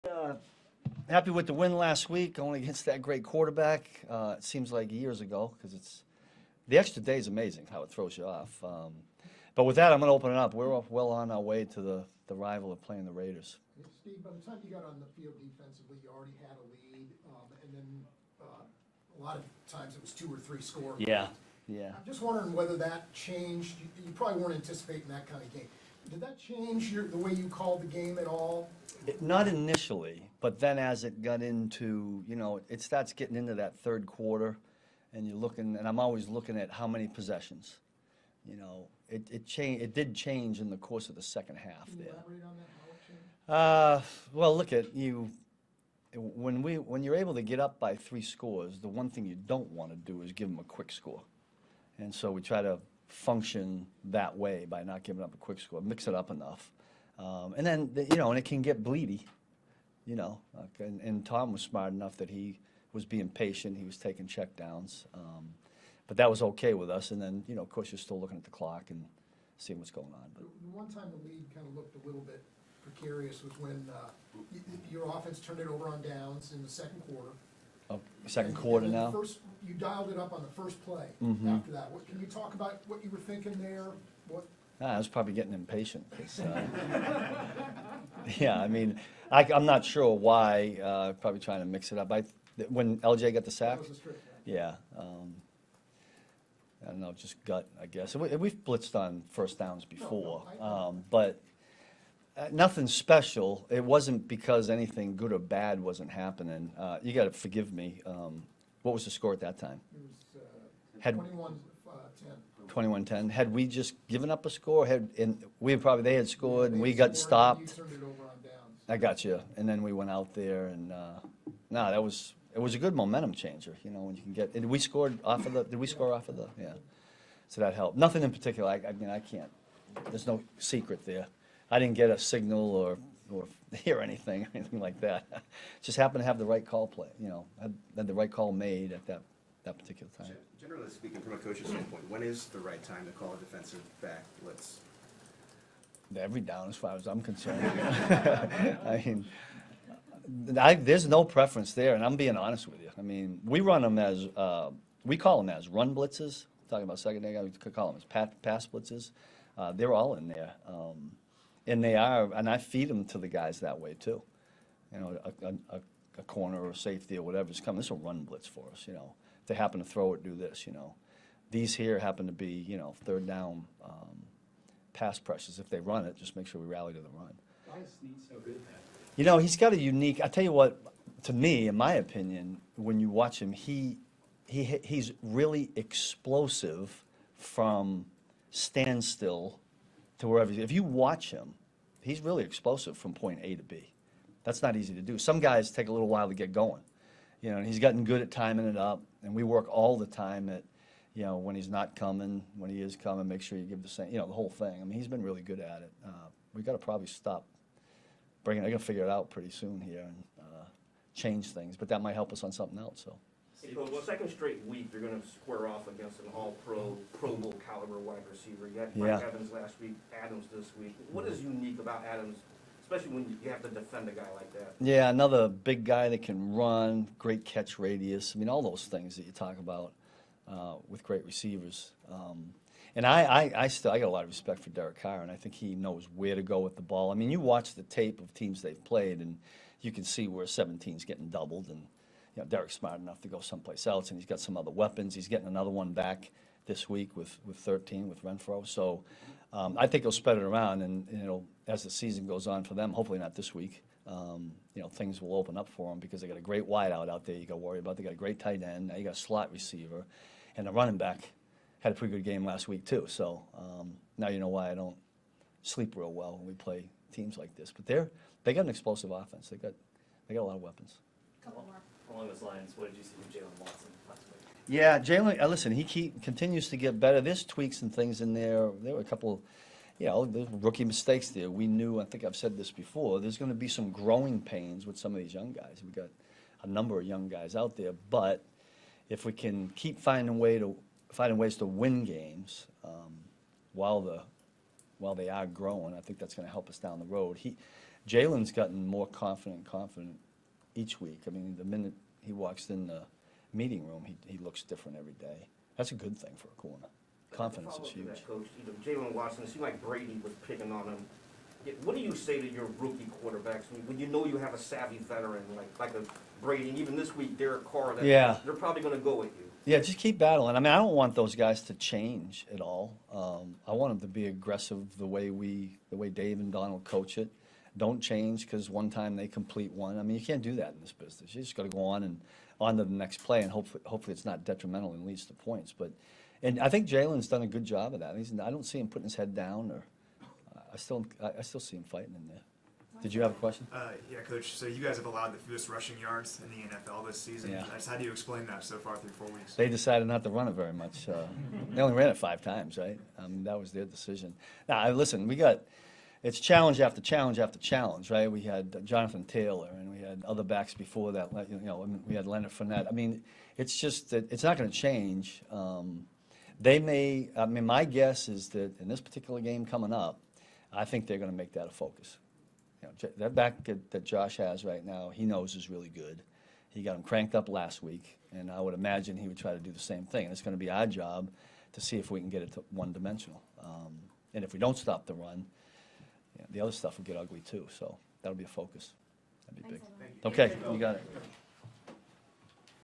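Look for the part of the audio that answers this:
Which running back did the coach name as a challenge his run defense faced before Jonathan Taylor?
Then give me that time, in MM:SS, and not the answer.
06:02.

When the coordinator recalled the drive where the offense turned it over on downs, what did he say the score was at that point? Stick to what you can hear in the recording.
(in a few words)
21-10.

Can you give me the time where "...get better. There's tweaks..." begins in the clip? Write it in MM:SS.
04:36.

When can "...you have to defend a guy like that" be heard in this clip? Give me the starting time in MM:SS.
03:43.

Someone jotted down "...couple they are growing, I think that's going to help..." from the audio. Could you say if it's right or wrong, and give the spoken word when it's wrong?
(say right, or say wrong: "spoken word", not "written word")
wrong: "while", not "couple".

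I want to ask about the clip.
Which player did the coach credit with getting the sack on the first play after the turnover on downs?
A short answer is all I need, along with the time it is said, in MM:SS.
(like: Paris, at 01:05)
LJ, at 01:33.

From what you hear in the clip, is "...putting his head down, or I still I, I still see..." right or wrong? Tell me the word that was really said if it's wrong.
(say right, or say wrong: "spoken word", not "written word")
right.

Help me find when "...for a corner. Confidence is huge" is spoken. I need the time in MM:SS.
05:06.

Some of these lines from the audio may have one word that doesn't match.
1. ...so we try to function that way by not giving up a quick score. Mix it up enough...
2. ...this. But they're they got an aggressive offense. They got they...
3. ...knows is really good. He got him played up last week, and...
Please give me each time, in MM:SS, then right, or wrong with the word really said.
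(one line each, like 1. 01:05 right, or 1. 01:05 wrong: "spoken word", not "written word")
1. 00:52 right
2. 04:27 wrong: "explosive", not "aggressive"
3. 06:15 wrong: "cranked", not "played".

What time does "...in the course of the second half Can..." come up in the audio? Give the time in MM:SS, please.
00:40.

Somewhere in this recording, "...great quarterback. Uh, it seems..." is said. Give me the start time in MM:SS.
00:03.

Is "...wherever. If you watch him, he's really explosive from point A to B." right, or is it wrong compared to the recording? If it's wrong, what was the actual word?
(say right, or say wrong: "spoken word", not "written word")
right.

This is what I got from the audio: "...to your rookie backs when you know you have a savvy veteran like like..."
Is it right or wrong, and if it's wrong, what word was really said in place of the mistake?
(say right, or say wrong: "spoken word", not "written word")
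wrong: "quarterbacks", not "backs".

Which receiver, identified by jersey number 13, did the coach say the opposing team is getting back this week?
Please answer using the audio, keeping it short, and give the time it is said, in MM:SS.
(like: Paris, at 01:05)
Renfrow, at 04:08.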